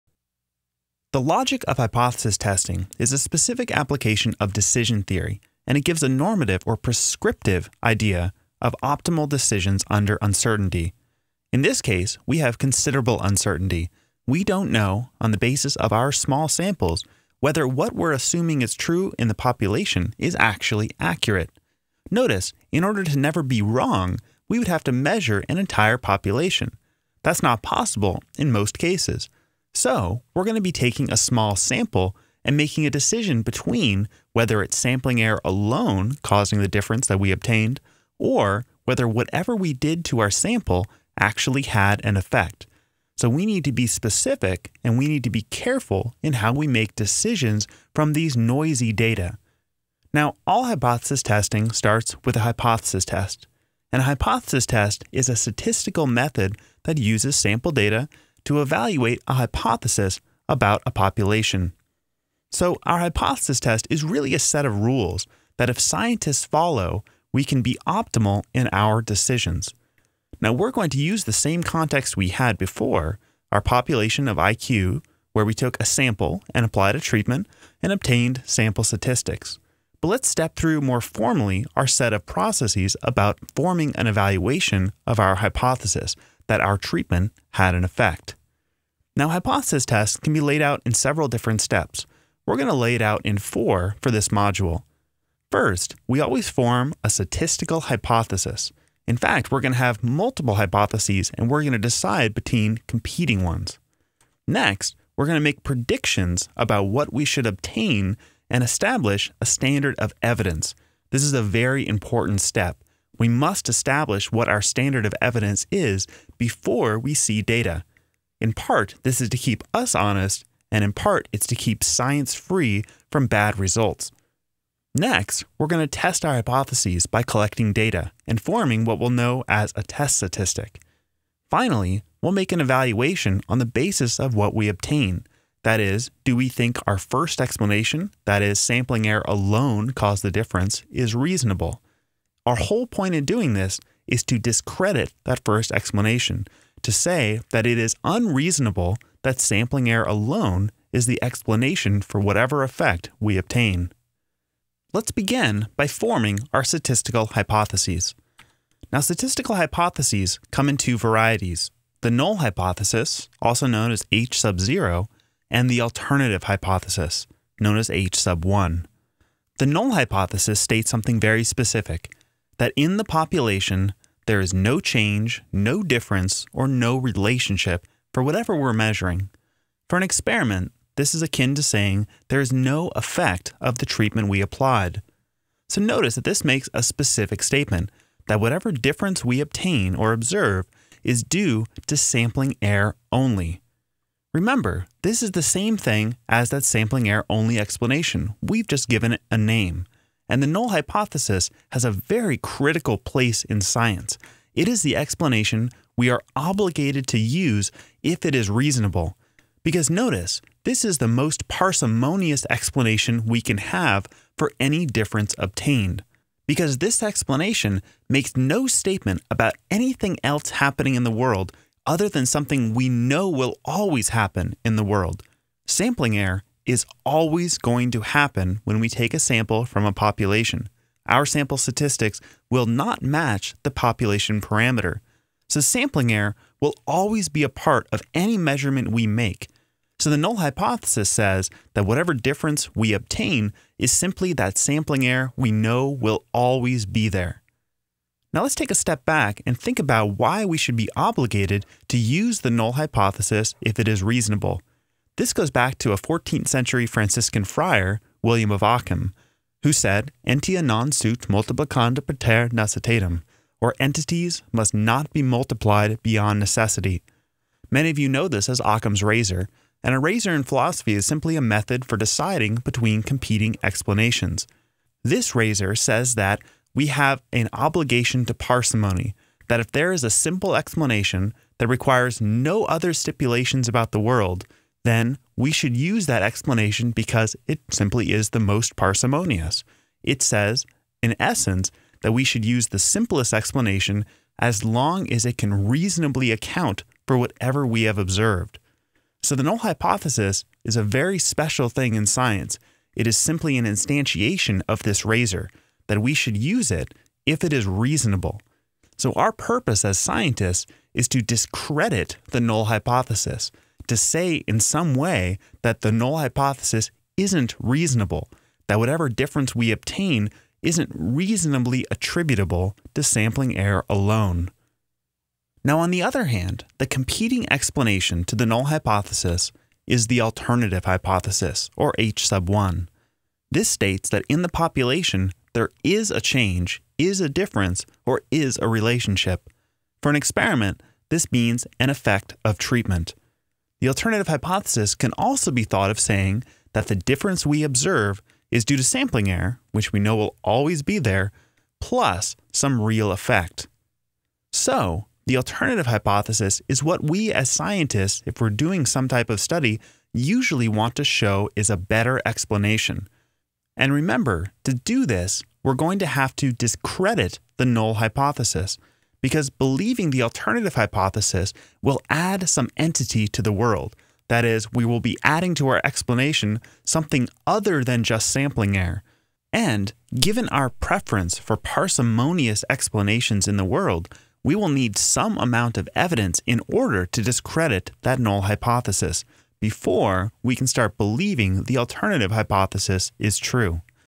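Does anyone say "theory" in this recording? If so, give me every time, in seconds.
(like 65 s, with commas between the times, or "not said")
5 s.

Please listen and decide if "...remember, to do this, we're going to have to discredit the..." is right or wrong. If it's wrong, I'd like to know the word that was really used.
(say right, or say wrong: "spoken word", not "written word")
right.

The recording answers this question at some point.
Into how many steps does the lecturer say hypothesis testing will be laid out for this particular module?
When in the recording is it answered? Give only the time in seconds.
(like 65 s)
93 s.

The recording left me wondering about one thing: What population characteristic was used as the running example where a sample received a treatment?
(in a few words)
IQ.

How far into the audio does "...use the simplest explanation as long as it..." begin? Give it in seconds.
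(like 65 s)
292 s.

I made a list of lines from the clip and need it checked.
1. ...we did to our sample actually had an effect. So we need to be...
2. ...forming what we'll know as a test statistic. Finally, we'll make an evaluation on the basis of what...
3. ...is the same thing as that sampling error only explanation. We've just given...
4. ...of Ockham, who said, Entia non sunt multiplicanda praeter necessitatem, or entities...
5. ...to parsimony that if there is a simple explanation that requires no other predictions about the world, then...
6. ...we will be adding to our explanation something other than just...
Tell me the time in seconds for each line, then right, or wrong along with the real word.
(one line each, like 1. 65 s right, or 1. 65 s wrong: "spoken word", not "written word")
1. 39 s right
2. 128 s right
3. 195 s right
4. 258 s right
5. 278 s wrong: "stipulations", not "predictions"
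6. 374 s right.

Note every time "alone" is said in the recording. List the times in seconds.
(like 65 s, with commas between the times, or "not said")
35 s, 139 s, 150 s, 323 s.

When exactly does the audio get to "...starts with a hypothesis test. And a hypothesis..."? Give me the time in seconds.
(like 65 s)
51 s.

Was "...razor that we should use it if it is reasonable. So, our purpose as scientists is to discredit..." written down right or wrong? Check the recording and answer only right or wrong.
right.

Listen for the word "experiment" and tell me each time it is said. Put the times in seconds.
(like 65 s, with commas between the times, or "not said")
180 s, 340 s.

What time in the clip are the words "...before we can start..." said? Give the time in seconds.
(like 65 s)
389 s.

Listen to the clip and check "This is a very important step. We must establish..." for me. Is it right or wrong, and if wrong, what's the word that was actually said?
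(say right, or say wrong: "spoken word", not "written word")
right.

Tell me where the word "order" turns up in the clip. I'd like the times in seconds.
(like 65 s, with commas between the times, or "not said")
22 s, 386 s.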